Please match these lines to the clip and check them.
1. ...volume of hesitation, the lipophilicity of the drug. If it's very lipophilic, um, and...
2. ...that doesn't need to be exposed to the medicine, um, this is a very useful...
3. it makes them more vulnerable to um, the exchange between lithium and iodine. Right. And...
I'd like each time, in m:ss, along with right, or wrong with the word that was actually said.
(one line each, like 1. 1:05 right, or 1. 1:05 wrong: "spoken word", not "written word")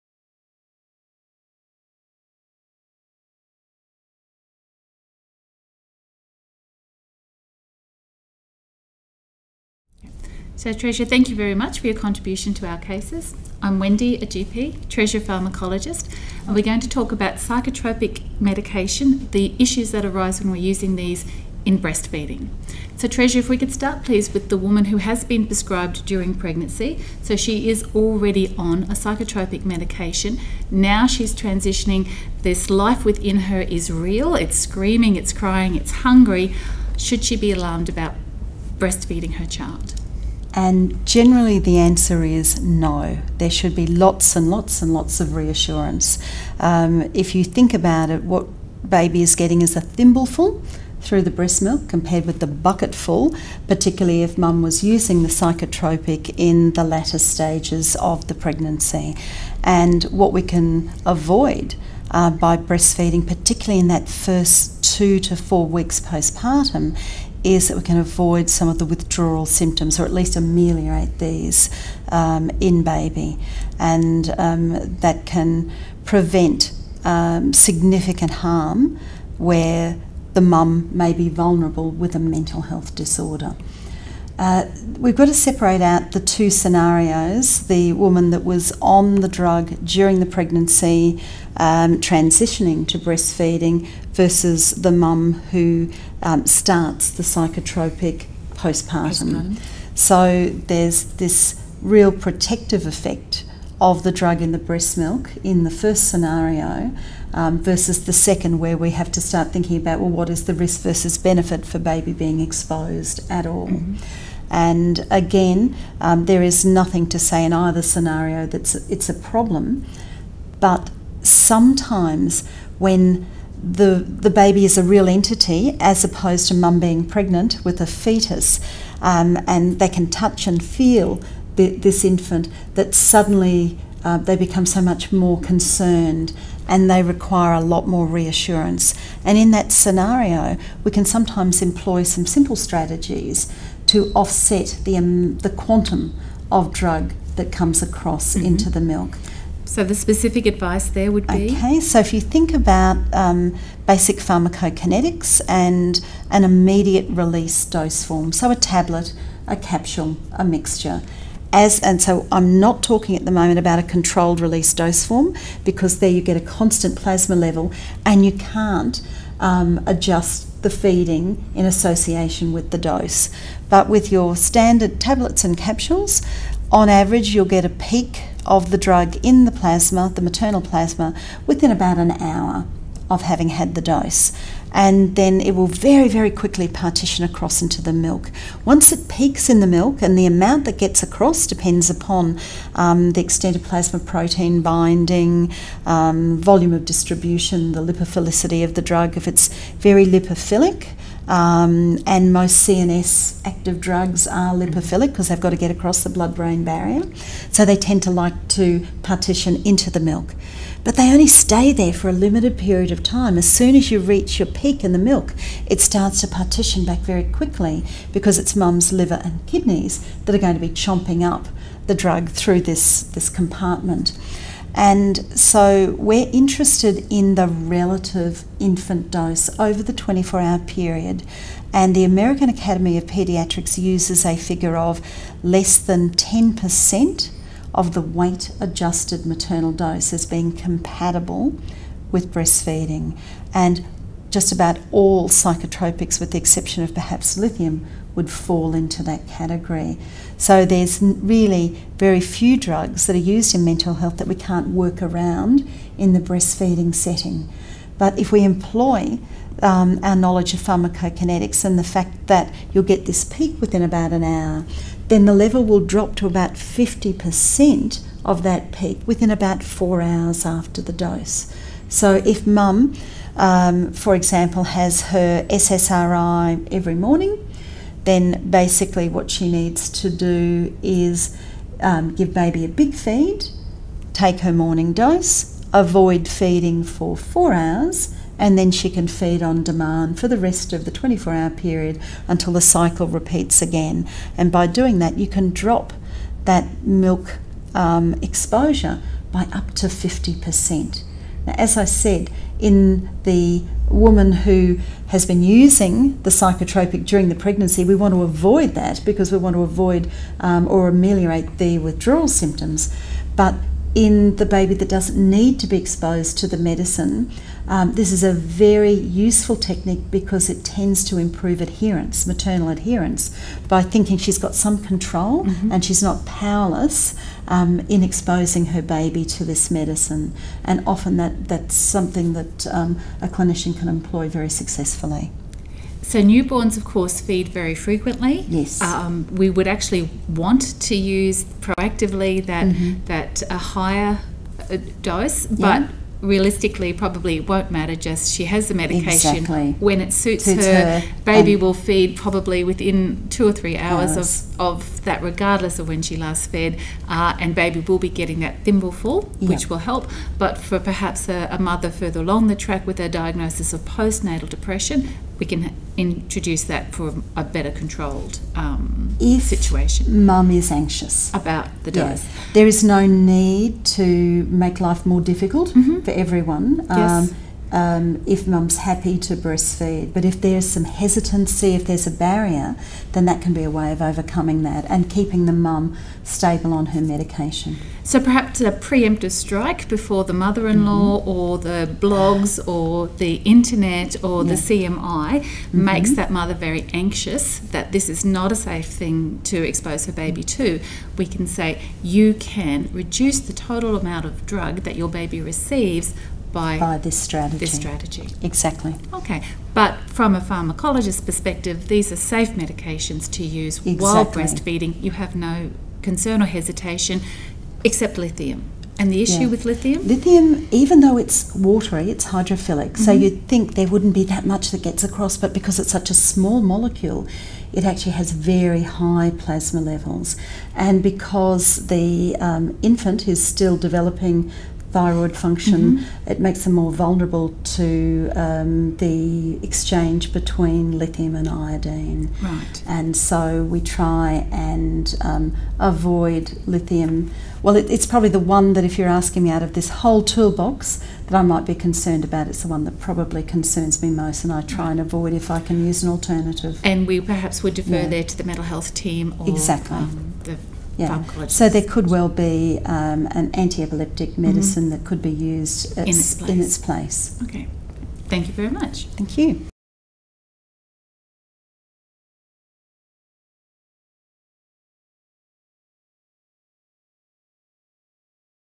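1. 3:16 wrong: "distribution", not "hesitation"
2. 5:14 right
3. 7:16 right.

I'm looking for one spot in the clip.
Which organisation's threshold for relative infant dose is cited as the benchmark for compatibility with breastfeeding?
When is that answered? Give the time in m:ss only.
3:52.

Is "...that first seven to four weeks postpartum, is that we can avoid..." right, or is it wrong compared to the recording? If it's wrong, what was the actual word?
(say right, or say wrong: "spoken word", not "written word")
wrong: "two", not "seven".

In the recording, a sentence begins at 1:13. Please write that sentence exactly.
And um, that can prevent um, significant harm where the mum may be vulnerable with a mental health disorder.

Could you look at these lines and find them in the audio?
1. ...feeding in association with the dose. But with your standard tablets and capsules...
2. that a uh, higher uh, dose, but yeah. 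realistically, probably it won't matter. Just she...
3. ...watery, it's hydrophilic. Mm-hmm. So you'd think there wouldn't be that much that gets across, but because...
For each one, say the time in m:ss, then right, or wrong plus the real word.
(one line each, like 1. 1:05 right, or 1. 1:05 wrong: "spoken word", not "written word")
1. 2:50 right
2. 5:43 right
3. 7:01 right.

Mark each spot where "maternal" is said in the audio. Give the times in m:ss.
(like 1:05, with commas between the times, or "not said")
3:00, 3:59, 5:22.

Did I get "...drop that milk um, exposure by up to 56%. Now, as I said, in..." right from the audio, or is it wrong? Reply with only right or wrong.
wrong.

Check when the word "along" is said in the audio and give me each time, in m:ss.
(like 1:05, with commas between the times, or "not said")
6:02.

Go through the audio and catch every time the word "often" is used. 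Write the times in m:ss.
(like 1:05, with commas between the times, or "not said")
5:30.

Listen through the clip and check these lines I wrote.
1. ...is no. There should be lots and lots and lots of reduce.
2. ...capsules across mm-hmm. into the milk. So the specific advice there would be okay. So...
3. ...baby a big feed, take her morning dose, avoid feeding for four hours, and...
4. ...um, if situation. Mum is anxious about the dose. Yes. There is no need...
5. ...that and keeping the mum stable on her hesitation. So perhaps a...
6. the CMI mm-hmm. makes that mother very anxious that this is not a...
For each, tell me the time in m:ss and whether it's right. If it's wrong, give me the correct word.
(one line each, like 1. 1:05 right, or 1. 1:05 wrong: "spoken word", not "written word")
1. 0:42 wrong: "reassurance", not "reduce"
2. 2:27 wrong: "comes", not "capsules"
3. 4:42 right
4. 6:08 right
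5. 6:24 wrong: "medication", not "hesitation"
6. 6:34 right.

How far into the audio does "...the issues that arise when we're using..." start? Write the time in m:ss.
0:19.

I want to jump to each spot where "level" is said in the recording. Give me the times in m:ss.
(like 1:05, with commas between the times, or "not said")
2:47, 4:25, 7:09.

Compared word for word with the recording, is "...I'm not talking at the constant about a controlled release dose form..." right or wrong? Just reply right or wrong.
wrong.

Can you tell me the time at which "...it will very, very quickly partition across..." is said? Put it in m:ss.
3:05.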